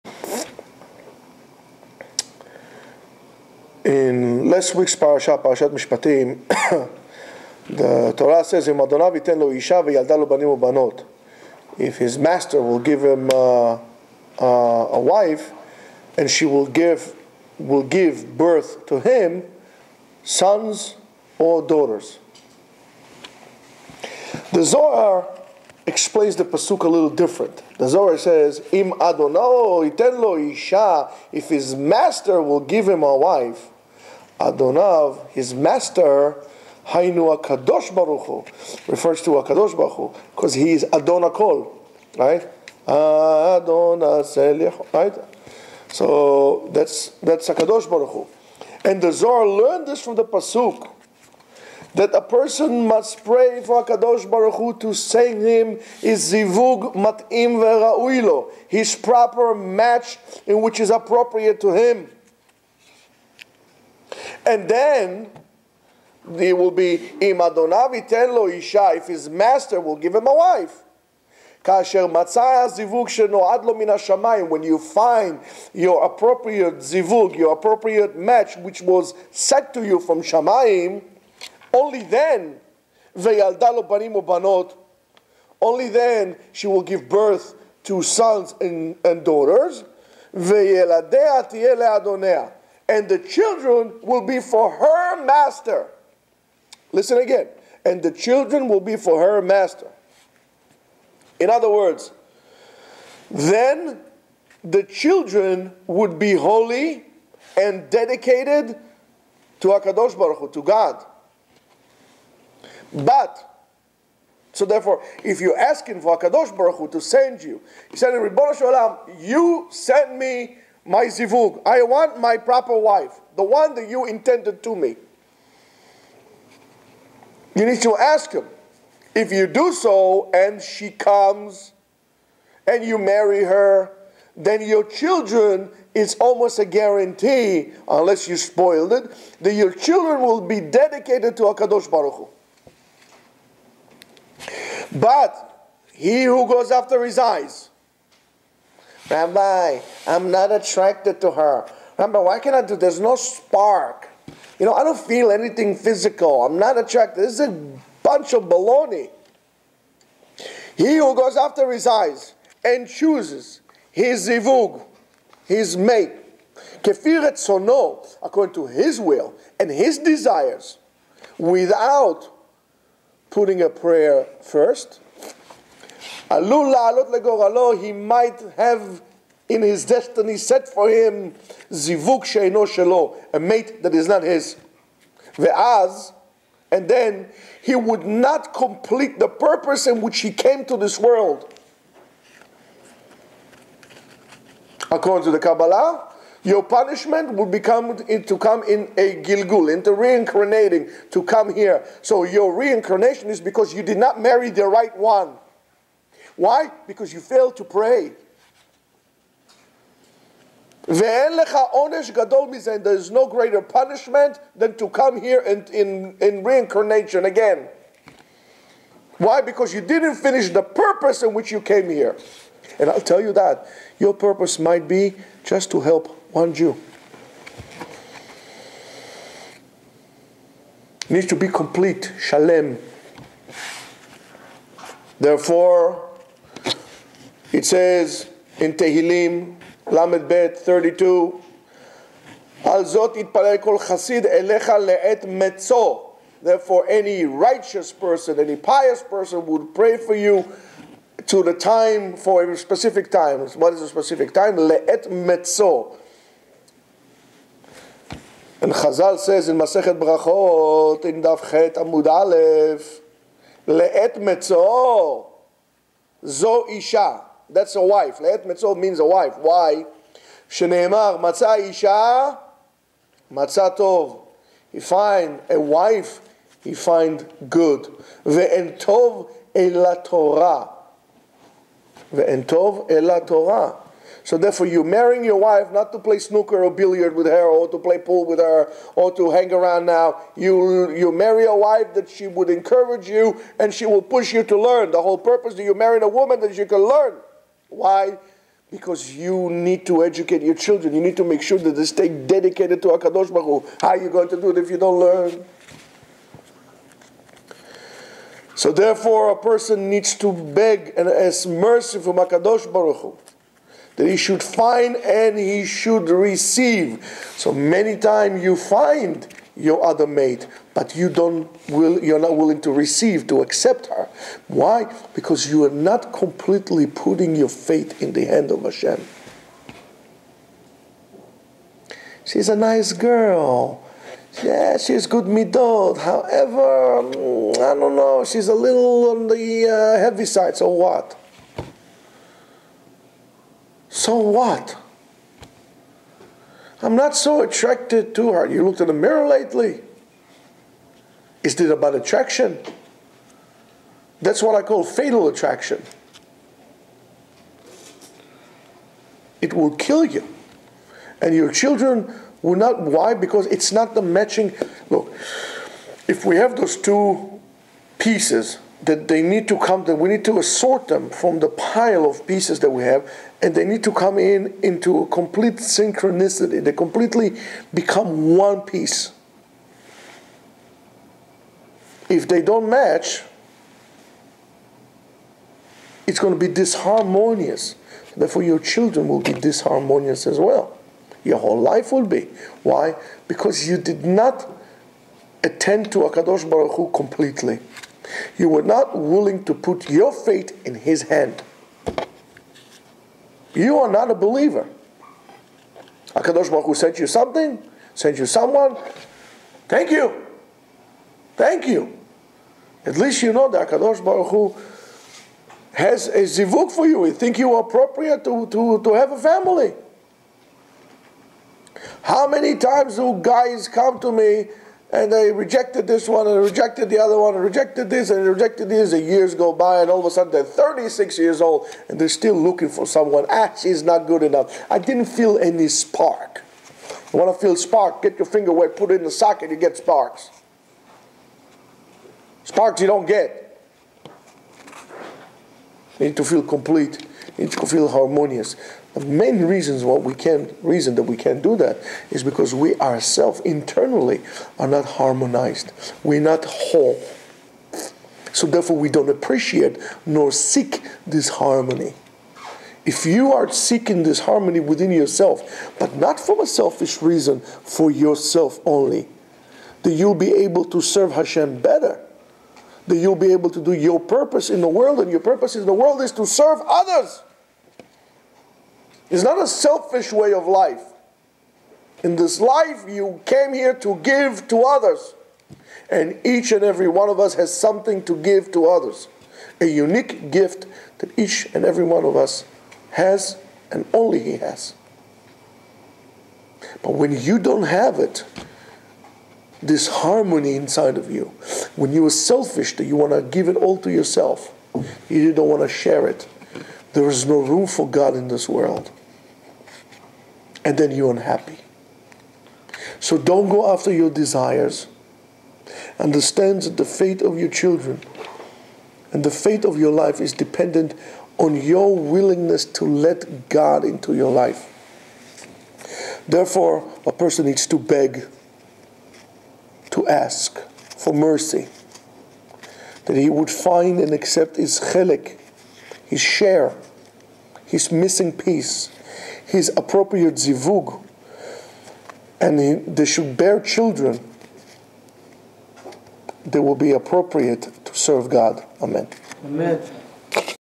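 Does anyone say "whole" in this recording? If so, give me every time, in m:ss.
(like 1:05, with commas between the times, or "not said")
4:55, 6:31, 7:36.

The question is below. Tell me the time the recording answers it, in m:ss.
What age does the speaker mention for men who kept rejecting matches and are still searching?
7:10.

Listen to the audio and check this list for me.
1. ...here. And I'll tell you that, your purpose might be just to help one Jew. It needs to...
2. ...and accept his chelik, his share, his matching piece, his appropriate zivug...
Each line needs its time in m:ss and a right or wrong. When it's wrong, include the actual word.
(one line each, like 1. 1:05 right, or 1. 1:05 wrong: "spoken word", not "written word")
1. 3:41 right
2. 8:53 wrong: "missing", not "matching".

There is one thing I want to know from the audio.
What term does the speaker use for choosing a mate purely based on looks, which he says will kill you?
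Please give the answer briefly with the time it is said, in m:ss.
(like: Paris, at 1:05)
Fatal attraction, at 5:54.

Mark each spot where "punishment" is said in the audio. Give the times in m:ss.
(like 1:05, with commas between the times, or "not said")
3:16, 3:33.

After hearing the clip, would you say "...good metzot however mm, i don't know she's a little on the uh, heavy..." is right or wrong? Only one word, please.
wrong.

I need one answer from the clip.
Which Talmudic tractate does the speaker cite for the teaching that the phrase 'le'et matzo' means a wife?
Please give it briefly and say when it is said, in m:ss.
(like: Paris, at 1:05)
Brachot, at 4:19.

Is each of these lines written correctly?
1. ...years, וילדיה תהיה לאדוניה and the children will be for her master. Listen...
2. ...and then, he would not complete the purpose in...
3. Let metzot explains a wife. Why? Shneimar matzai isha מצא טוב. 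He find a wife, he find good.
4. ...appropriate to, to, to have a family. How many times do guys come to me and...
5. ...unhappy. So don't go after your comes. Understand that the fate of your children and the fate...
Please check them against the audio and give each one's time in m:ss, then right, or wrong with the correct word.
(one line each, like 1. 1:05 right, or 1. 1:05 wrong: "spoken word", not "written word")
1. 1:29 wrong: "daughters", not "years"
2. 3:06 right
3. 4:28 wrong: "means", not "explains"
4. 6:57 right
5. 8:31 wrong: "desires", not "comes".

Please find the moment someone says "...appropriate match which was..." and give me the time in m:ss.
1:17.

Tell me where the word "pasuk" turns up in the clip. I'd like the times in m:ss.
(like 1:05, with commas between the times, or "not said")
0:26, 0:50.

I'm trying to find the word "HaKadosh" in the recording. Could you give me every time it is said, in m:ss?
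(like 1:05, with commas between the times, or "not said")
1:49, 1:56, 2:21, 5:02, 5:12.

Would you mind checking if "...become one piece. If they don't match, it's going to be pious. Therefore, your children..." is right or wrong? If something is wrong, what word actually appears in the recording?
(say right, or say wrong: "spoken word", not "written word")
wrong: "disharmonious", not "pious".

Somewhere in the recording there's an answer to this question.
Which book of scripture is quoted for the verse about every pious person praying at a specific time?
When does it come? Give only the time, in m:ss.
3:58.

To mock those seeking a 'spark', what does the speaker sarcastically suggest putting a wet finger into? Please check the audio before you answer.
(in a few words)
The socket.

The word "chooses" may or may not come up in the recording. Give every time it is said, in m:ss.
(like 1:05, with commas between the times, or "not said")
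2:42.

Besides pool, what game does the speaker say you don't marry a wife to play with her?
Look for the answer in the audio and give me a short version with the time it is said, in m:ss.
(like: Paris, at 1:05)
Snooker, at 4:46.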